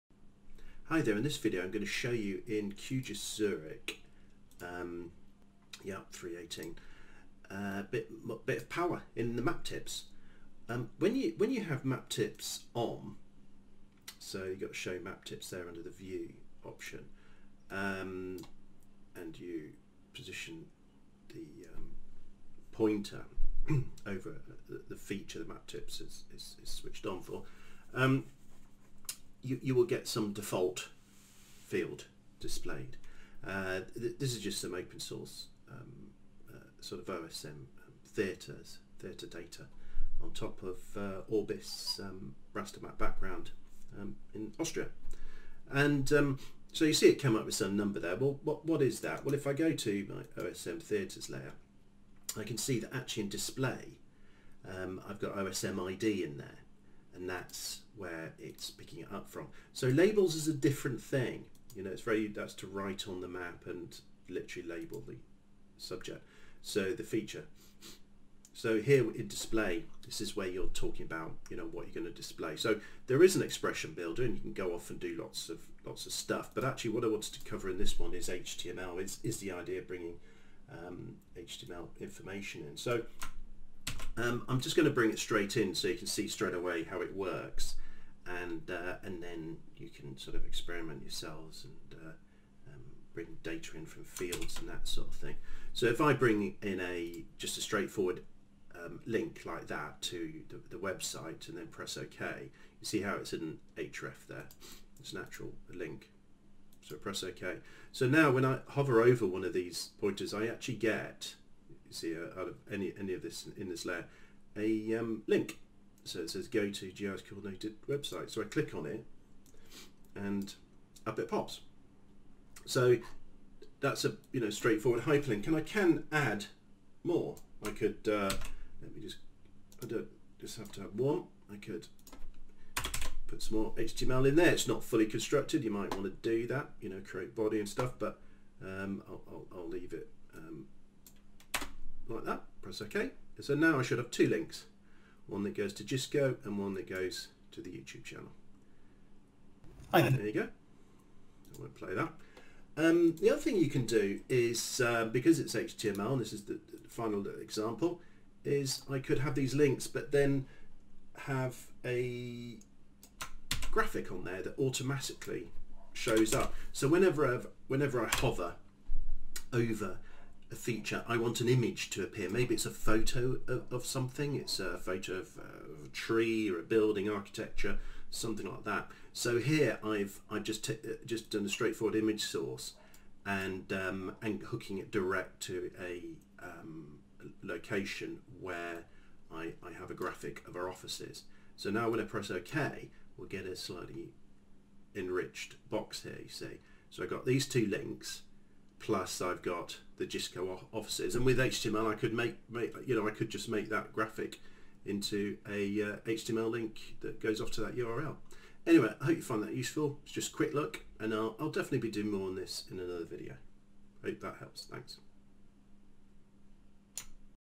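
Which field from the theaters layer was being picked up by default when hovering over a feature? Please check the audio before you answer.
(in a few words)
OSM ID.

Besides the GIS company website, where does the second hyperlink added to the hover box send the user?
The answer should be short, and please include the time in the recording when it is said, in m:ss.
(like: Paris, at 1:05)
YouTube channel, at 2:27.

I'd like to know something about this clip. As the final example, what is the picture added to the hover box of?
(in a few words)
GISCO offices.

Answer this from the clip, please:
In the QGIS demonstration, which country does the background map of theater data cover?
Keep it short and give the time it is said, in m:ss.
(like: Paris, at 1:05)
Austria, at 0:44.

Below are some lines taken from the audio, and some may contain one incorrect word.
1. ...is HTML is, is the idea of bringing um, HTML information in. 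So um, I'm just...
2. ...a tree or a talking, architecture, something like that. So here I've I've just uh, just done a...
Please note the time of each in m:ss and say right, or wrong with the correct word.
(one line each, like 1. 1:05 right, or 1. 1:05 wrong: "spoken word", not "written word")
1. 1:18 right
2. 2:55 wrong: "building", not "talking".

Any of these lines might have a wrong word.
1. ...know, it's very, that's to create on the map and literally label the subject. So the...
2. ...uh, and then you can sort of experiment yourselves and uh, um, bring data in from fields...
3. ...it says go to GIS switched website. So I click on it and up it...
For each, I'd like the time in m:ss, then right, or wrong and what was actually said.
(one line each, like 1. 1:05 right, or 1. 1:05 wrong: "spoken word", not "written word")
1. 1:01 wrong: "write", not "create"
2. 1:28 right
3. 1:56 wrong: "coordinated", not "switched".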